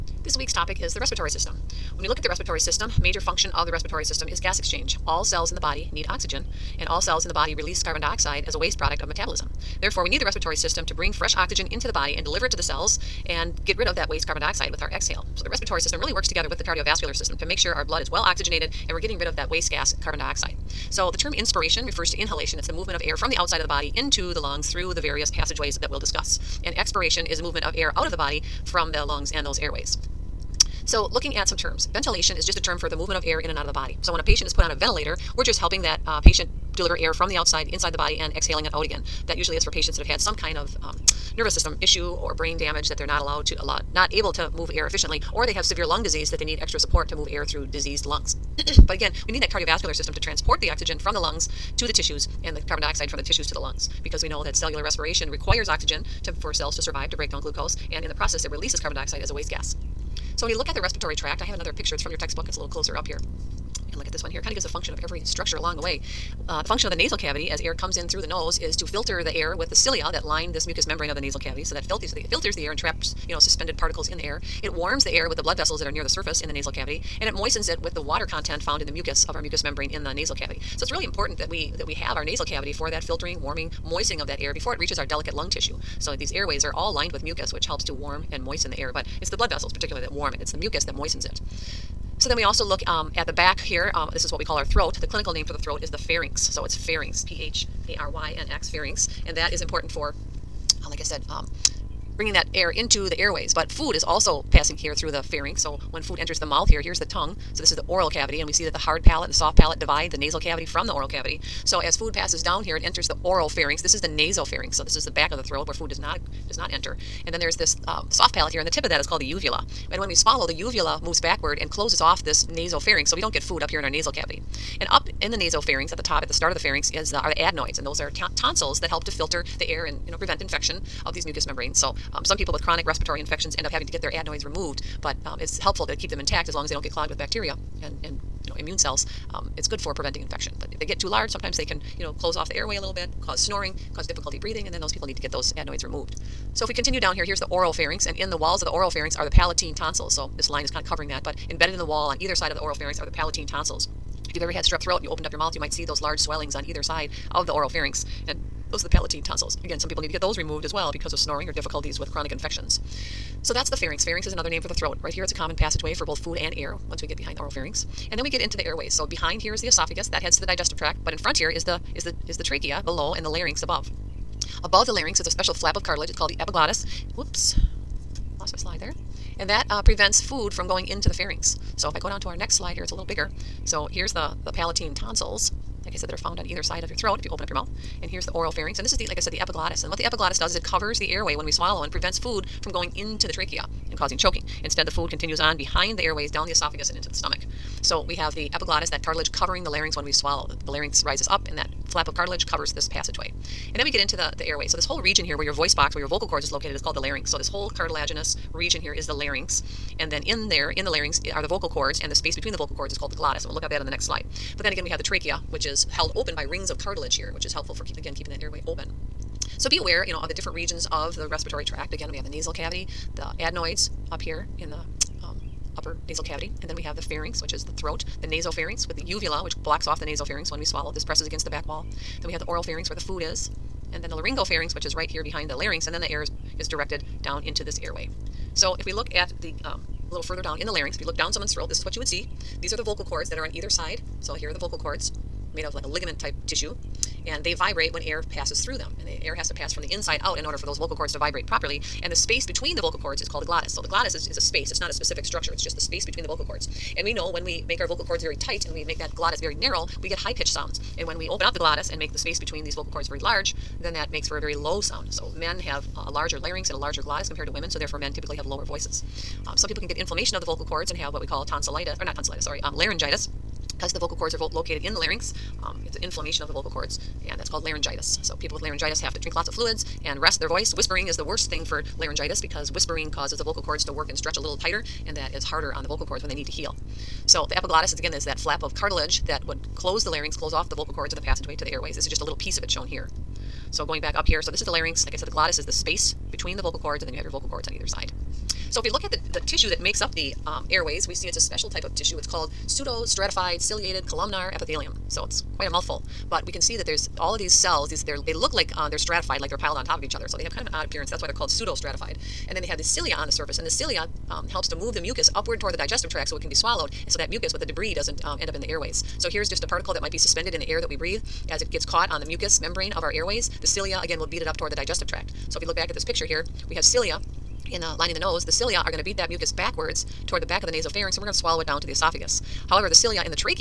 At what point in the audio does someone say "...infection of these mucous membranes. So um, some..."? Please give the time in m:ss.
2:10.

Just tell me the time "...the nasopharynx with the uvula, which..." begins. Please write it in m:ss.
3:48.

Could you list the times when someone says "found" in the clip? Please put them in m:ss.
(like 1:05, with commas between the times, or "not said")
1:18, 3:06.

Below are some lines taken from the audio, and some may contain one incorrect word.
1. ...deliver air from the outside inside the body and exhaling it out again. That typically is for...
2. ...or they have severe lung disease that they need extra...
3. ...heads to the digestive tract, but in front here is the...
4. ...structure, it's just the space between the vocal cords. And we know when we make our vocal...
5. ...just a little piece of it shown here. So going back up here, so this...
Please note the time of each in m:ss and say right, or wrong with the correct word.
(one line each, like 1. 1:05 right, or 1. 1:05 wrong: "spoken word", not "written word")
1. 0:36 wrong: "usually", not "typically"
2. 0:45 right
3. 2:50 right
4. 4:15 right
5. 4:52 right.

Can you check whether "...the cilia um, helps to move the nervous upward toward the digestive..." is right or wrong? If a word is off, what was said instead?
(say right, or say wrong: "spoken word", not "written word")
wrong: "mucus", not "nervous".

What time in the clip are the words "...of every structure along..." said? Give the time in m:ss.
1:04.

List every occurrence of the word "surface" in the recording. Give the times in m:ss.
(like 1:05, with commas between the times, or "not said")
1:16, 5:13.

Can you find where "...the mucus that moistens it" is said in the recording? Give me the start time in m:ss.
1:30.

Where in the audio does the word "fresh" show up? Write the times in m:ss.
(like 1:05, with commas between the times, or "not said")
0:11.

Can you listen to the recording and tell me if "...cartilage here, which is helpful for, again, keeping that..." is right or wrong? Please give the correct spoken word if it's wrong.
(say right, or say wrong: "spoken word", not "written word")
right.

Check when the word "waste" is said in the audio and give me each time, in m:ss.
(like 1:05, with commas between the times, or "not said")
0:08, 0:14, 0:19, 0:59.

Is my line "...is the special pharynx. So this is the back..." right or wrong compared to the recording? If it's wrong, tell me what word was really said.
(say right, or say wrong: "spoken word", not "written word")
wrong: "nasal", not "special".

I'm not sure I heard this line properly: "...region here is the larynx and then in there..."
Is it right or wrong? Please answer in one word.
right.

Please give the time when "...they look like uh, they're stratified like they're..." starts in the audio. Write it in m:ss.
5:08.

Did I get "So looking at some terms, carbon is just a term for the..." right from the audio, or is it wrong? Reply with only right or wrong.
wrong.